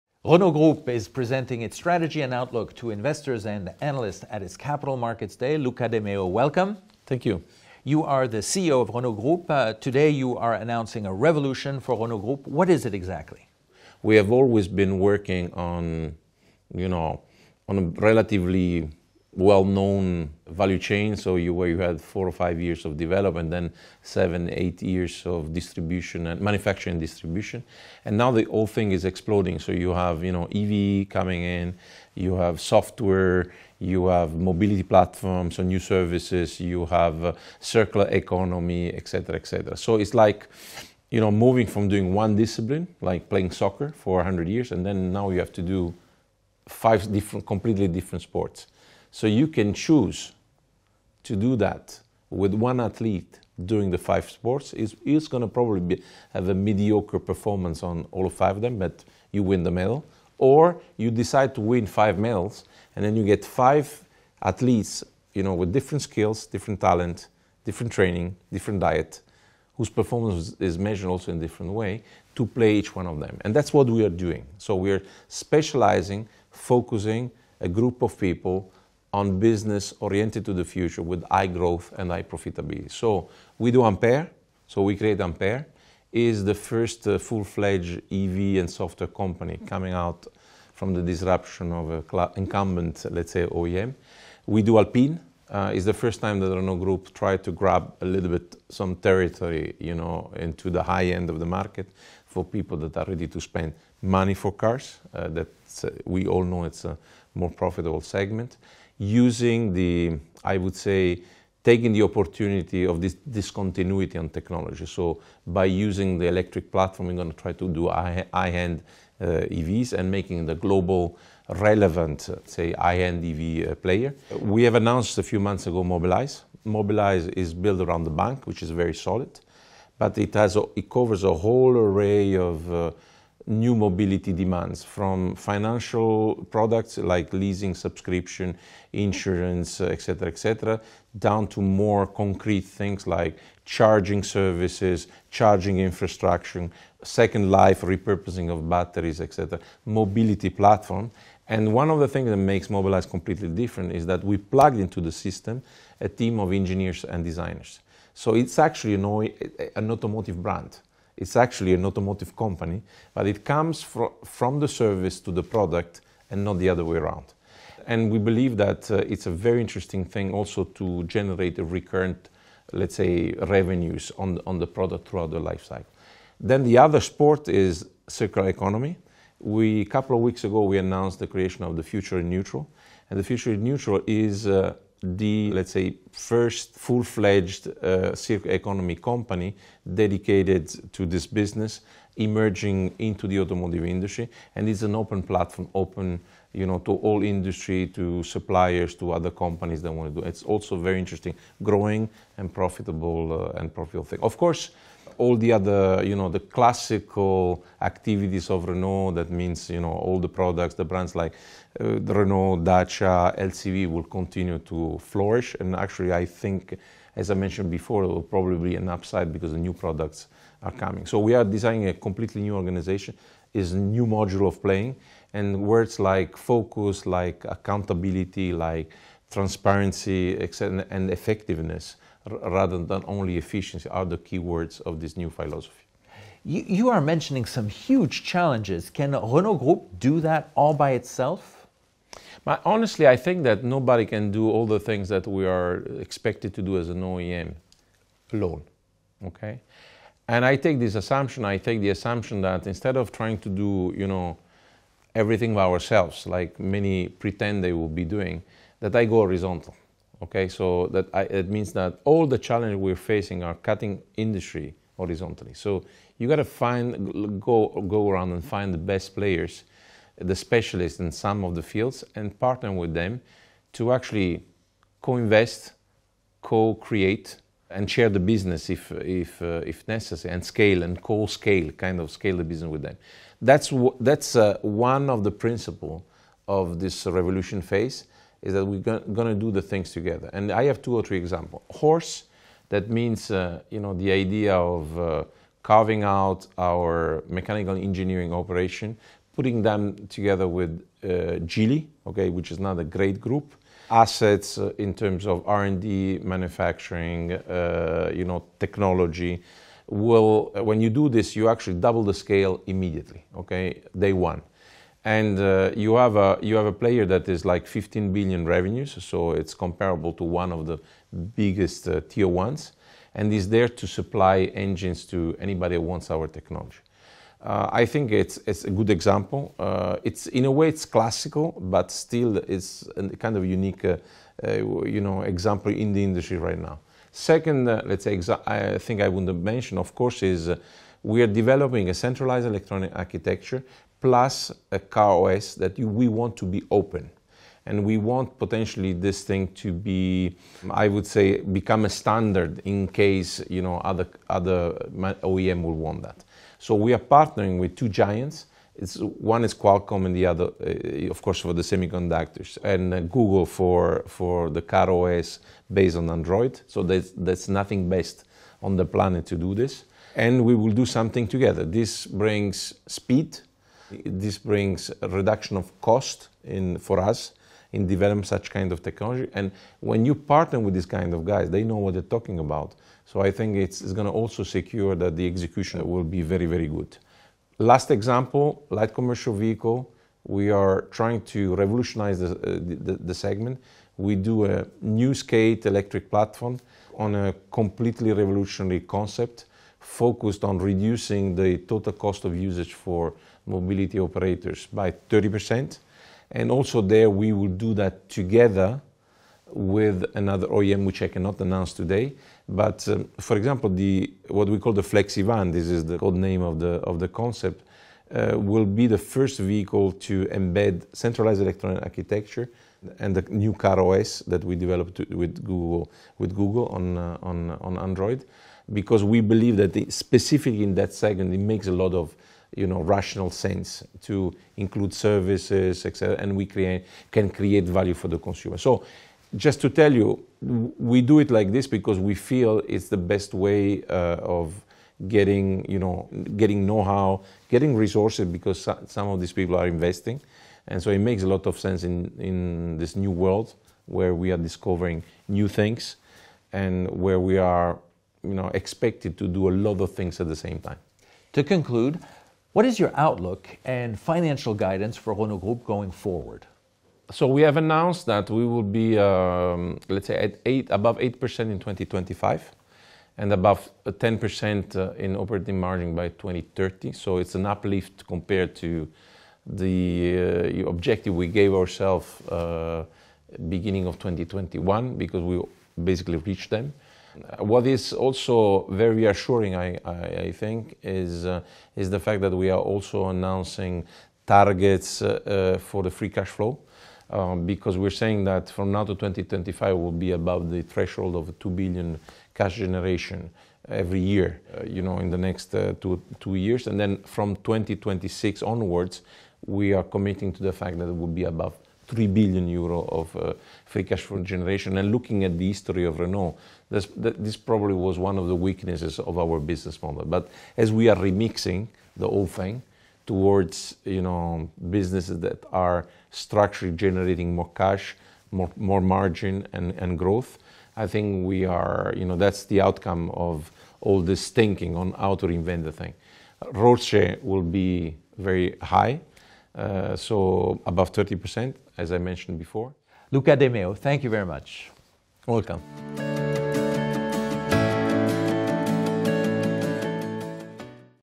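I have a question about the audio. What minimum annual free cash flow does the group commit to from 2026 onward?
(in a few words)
3 billion euros.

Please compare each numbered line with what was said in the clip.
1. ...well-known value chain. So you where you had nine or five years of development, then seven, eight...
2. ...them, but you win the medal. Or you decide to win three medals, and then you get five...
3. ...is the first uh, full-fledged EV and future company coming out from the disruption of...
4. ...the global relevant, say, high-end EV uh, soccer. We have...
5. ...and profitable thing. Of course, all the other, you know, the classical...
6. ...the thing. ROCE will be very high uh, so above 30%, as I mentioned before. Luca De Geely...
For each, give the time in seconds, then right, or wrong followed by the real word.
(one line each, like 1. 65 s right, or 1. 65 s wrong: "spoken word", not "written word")
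1. 19 s wrong: "four", not "nine"
2. 58 s wrong: "five", not "three"
3. 86 s wrong: "software", not "future"
4. 120 s wrong: "player", not "soccer"
5. 203 s right
6. 535 s wrong: "Meo", not "Geely".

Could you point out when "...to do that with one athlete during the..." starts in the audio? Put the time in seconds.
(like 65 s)
51 s.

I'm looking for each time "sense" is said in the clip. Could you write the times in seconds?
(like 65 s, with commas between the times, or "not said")
433 s, 451 s.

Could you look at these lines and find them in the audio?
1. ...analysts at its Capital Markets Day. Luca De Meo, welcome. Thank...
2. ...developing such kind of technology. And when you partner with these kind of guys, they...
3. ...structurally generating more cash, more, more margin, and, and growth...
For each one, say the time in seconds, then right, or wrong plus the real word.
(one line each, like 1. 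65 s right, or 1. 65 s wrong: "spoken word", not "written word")
1. 3 s right
2. 377 s right
3. 526 s right.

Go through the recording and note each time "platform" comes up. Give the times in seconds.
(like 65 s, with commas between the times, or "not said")
34 s, 116 s, 150 s, 195 s, 396 s.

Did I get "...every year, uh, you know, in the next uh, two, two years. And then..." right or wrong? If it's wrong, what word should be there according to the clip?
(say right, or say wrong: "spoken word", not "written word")
right.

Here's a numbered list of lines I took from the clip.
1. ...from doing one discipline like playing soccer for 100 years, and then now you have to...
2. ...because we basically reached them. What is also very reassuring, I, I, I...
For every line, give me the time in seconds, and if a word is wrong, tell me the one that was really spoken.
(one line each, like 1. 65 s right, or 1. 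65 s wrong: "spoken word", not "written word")
1. 41 s right
2. 484 s right.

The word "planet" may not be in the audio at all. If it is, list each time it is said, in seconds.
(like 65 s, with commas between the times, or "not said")
368 s.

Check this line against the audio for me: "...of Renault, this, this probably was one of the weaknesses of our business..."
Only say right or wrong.
right.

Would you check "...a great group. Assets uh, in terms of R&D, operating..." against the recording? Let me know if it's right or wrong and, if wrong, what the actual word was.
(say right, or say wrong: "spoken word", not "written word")
wrong: "manufacturing", not "operating".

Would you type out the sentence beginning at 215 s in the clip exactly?
And actually, I think, as I mentioned before, it will probably be an upside because the new products are coming.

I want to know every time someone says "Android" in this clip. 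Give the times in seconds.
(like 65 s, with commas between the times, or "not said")
366 s, 427 s.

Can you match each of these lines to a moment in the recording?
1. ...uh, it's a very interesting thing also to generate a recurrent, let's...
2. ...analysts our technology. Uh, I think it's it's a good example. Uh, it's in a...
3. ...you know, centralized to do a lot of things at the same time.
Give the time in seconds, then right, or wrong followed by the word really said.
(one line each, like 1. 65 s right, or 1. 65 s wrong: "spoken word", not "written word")
1. 168 s right
2. 325 s wrong: "wants", not "analysts"
3. 458 s wrong: "expected", not "centralized".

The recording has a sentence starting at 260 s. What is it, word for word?
Okay, so that I, it means that all the challenges we're facing are cutting industry horizontally.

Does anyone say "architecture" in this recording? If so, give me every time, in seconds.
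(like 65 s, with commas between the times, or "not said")
342 s, 421 s.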